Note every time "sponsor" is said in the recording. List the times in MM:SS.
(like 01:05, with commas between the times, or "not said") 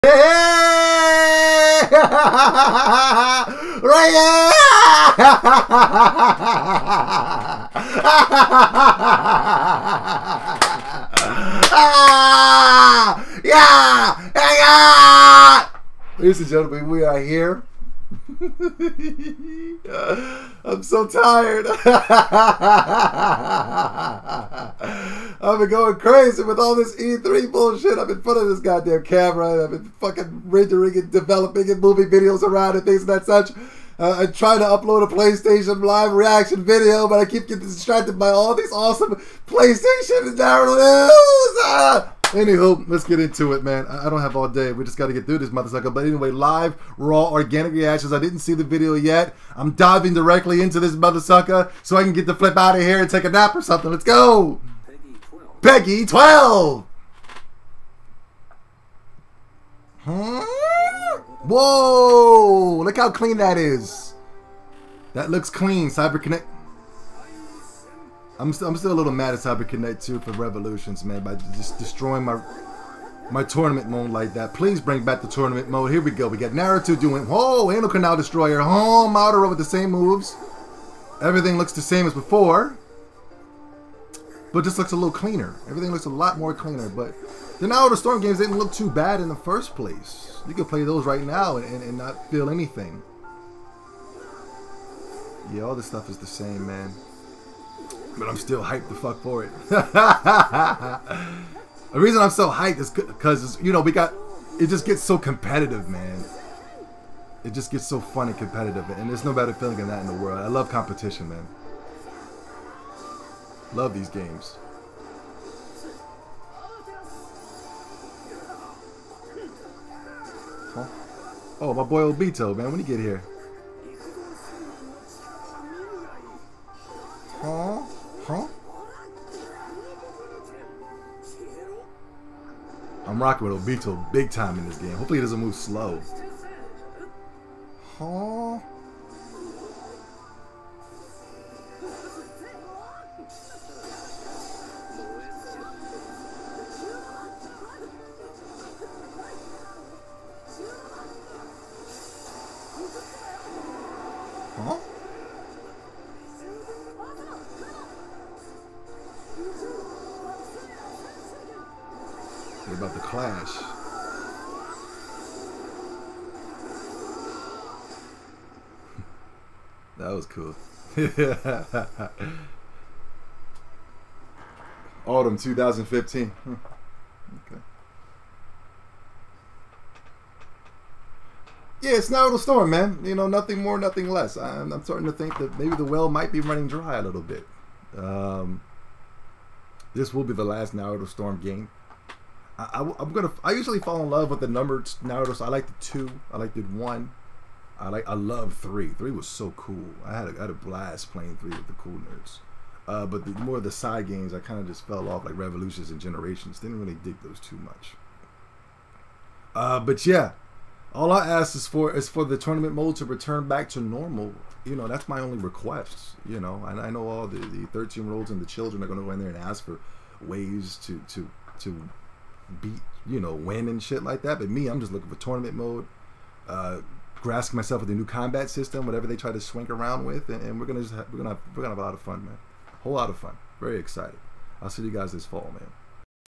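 not said.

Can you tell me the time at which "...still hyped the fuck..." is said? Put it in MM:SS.
01:38.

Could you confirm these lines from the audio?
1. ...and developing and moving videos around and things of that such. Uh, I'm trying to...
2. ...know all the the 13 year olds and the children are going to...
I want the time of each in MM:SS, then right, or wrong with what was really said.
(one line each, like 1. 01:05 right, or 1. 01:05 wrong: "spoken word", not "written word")
1. 00:30 right
2. 03:36 right.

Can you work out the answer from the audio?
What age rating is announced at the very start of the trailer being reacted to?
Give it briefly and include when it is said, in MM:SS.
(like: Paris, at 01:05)
PEGI 12, at 00:55.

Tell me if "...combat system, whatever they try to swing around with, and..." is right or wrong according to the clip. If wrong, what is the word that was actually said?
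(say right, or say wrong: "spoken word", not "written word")
right.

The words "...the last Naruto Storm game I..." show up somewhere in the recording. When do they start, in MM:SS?
03:10.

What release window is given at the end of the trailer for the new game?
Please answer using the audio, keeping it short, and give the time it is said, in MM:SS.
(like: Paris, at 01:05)
Autumn 2015, at 02:55.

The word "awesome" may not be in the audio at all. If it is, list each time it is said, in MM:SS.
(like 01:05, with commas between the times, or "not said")
00:38.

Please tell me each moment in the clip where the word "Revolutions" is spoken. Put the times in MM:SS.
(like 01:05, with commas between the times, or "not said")
01:10, 03:25.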